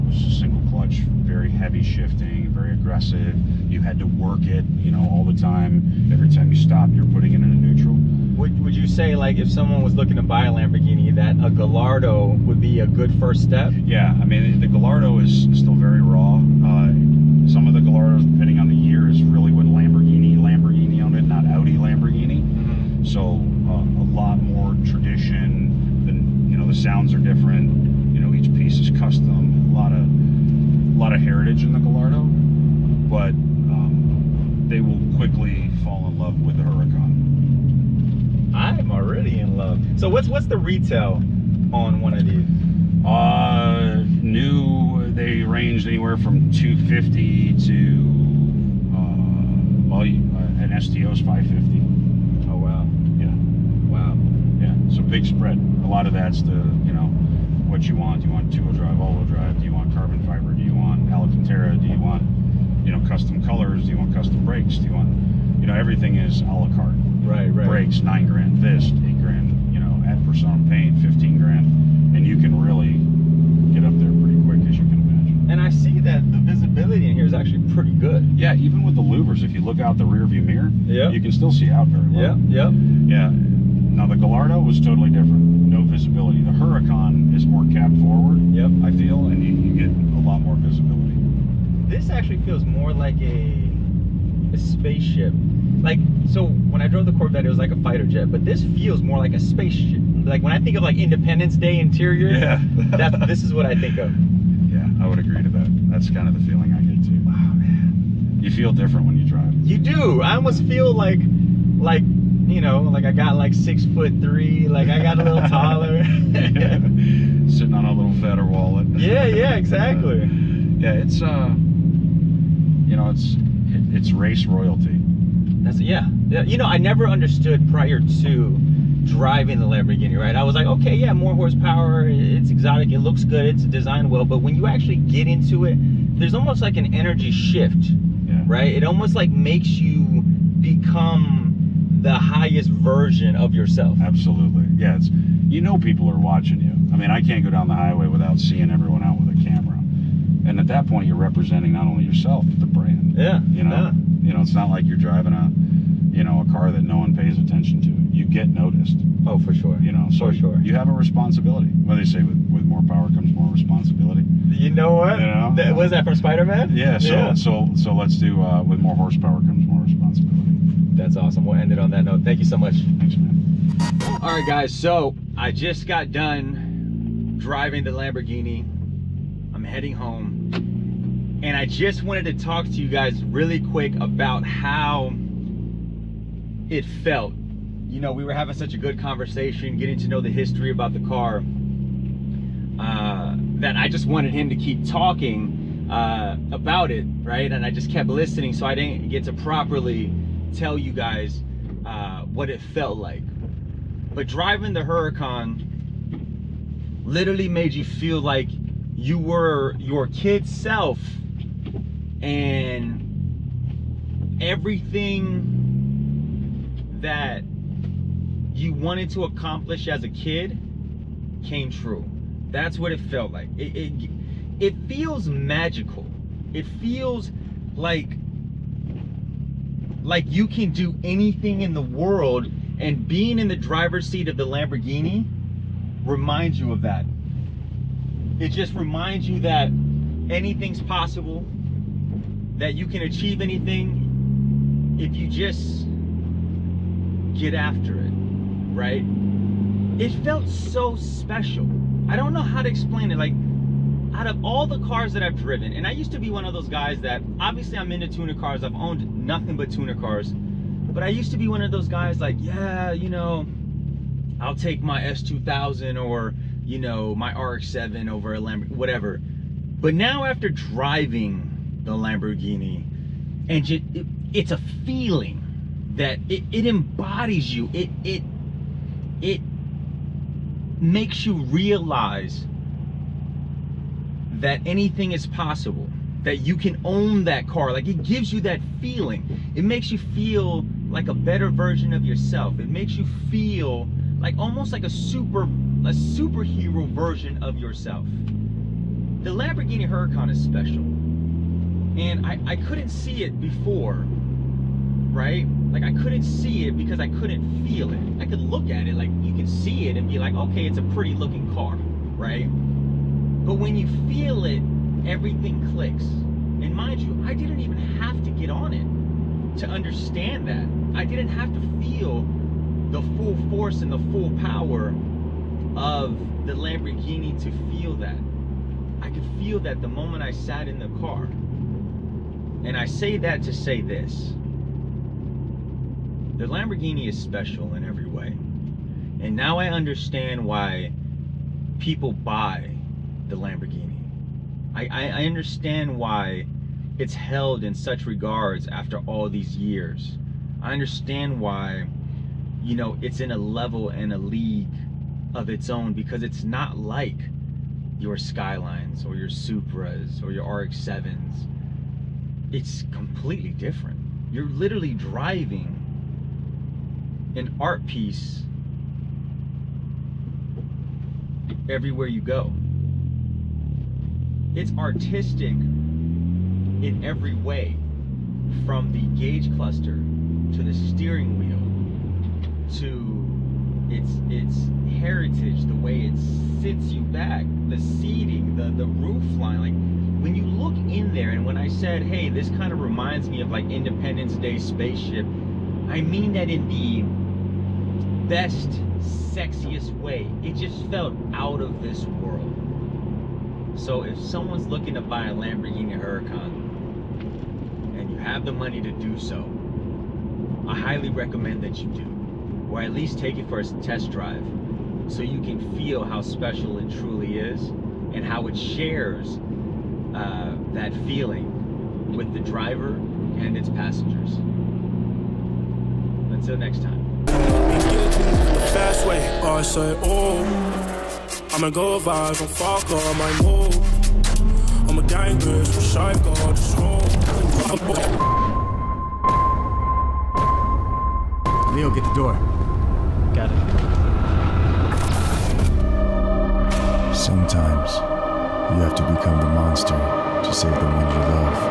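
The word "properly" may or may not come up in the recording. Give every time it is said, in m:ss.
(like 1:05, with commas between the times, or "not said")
3:19.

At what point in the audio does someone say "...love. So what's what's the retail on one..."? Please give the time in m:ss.
0:39.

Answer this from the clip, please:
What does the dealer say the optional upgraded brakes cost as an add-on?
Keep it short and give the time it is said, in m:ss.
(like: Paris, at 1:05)
nine grand, at 1:07.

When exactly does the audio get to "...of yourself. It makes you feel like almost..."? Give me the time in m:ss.
4:51.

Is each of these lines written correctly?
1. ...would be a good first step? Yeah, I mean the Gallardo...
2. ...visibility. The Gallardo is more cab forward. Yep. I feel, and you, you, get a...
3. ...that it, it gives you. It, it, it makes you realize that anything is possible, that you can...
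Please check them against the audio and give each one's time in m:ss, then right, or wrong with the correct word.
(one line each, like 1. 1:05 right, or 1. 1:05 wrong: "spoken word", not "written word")
1. 0:12 right
2. 1:25 wrong: "Huracan", not "Gallardo"
3. 4:35 wrong: "embodies", not "gives".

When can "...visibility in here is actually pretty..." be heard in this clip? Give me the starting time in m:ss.
1:16.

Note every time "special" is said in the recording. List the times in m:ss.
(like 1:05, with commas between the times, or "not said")
4:10, 5:00, 5:37, 6:56.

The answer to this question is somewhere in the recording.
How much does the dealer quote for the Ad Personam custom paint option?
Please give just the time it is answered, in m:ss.
1:11.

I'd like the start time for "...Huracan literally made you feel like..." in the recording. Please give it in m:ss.
3:24.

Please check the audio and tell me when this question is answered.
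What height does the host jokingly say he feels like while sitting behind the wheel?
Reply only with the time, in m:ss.
1:53.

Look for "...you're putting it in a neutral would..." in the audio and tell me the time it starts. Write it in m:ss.
0:06.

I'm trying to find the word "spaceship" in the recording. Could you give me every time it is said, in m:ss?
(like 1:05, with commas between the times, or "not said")
1:34, 1:39, 6:34.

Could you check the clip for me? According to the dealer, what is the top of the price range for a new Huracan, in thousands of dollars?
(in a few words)
550.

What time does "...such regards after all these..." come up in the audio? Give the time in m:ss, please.
5:47.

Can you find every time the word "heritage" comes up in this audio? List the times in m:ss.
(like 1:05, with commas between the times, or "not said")
0:31, 6:24.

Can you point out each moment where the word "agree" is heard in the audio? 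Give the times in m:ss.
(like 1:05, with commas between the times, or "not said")
1:45.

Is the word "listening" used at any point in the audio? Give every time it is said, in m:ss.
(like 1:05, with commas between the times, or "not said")
3:18.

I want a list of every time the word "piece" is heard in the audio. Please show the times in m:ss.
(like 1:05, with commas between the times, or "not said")
0:28, 6:07.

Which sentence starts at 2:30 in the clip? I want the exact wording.
And at that point, you're representing not only yourself, but the brand.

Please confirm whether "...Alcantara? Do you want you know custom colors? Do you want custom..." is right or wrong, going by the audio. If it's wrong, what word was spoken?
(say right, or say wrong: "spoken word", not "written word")
right.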